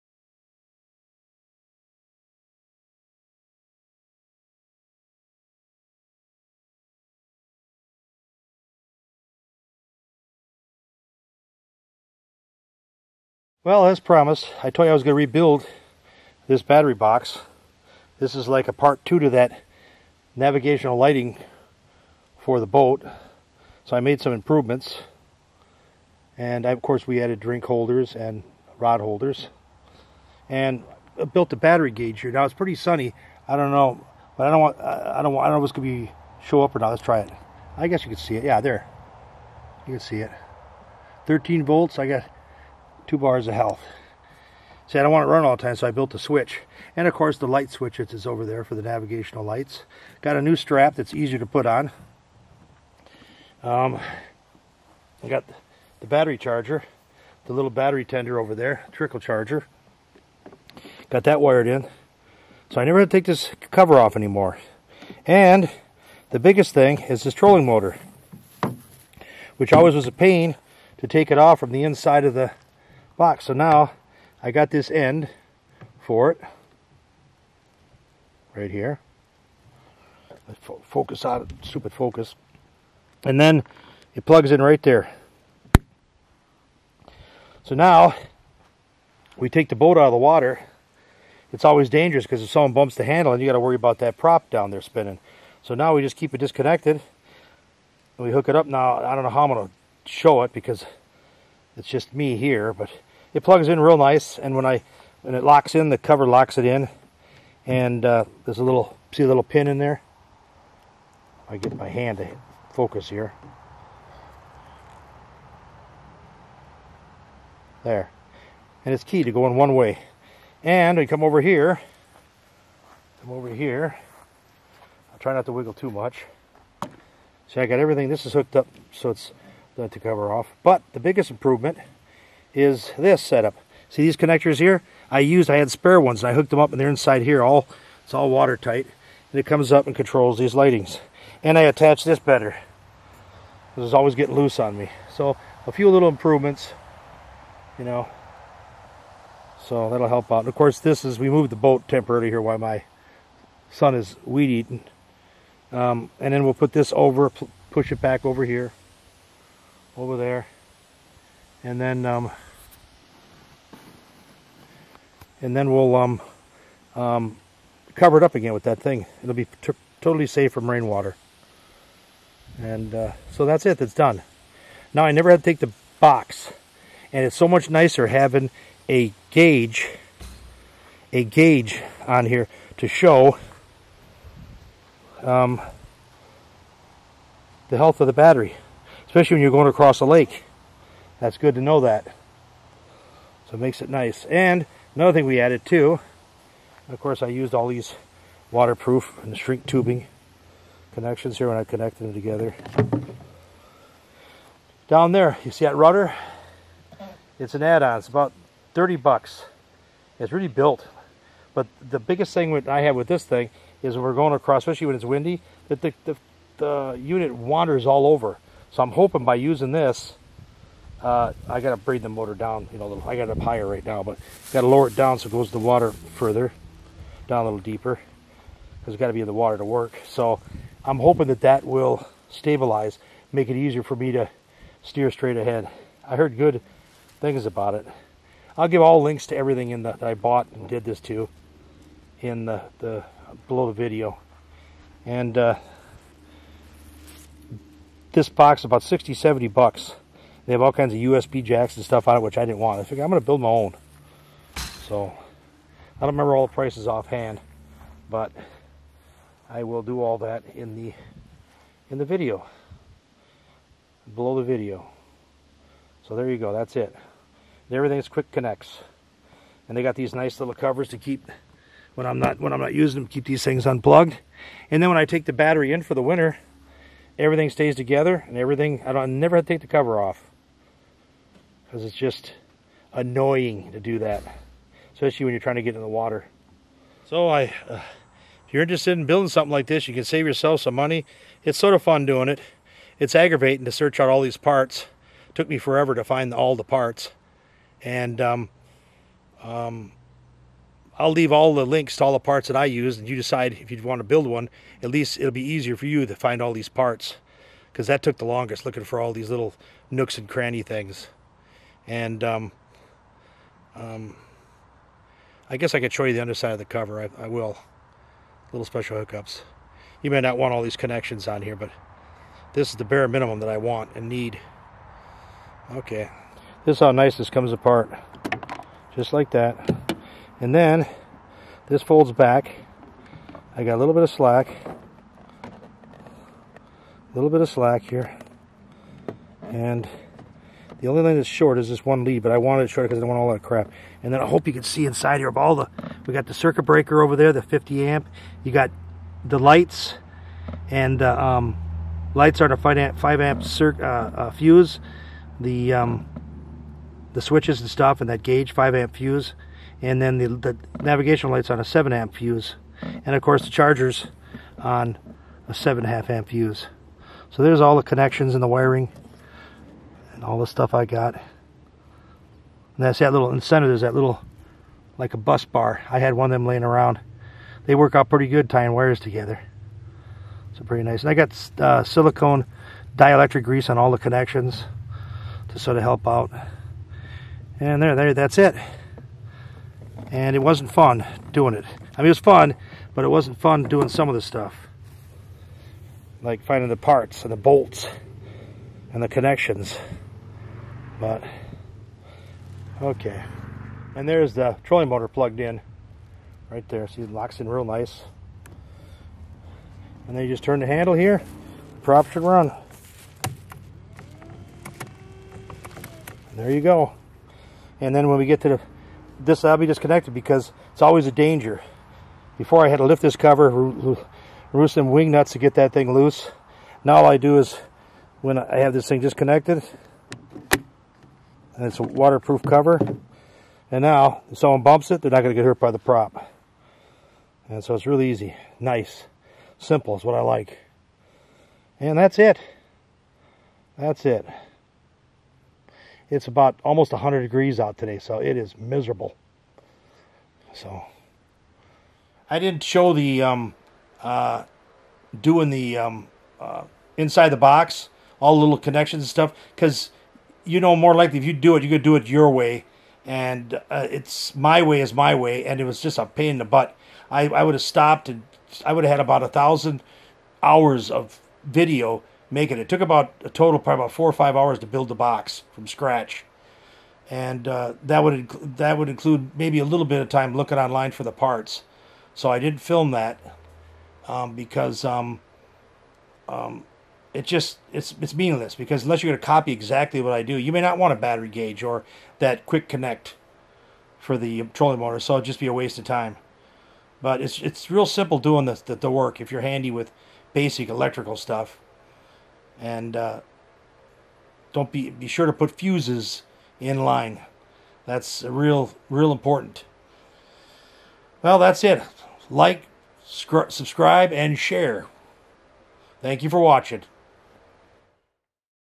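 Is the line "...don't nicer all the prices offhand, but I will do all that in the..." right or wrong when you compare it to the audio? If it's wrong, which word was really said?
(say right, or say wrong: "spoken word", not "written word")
wrong: "remember", not "nicer".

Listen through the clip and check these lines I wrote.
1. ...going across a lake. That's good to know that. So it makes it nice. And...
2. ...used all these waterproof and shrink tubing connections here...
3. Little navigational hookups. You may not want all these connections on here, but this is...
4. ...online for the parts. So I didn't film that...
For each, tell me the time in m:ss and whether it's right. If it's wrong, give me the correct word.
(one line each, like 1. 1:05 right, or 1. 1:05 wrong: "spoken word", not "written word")
1. 3:09 right
2. 3:17 right
3. 5:18 wrong: "special", not "navigational"
4. 8:00 right.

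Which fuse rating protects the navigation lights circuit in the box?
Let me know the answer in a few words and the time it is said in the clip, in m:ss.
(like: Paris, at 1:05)
7 amp, at 6:01.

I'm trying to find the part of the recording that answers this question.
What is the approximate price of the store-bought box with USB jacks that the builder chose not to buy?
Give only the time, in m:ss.
4:08.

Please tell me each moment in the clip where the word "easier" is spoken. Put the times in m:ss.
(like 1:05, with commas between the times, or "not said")
0:51, 3:53, 5:05.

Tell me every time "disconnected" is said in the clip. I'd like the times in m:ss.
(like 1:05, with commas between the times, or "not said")
1:36, 6:59, 7:09.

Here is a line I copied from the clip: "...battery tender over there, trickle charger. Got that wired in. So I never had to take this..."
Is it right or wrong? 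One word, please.
right.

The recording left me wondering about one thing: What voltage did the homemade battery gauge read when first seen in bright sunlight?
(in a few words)
13 volts.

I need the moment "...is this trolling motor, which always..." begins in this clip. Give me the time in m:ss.
1:07.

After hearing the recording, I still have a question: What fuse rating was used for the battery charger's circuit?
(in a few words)
7.5 amp.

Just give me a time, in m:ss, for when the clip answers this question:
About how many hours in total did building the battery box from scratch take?
7:53.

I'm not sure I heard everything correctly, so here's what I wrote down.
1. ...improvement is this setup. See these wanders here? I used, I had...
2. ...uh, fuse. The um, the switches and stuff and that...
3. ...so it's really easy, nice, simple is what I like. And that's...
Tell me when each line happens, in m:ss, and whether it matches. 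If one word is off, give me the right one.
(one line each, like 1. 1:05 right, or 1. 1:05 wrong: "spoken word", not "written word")
1. 2:11 wrong: "connectors", not "wanders"
2. 5:53 right
3. 7:17 right.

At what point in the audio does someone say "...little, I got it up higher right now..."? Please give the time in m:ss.
3:42.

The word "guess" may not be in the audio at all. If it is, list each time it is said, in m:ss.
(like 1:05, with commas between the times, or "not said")
0:37, 5:15.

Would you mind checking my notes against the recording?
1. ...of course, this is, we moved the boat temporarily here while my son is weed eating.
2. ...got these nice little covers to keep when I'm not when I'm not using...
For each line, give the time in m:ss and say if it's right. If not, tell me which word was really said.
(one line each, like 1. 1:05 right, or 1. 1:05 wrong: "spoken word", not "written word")
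1. 2:30 right
2. 4:29 right.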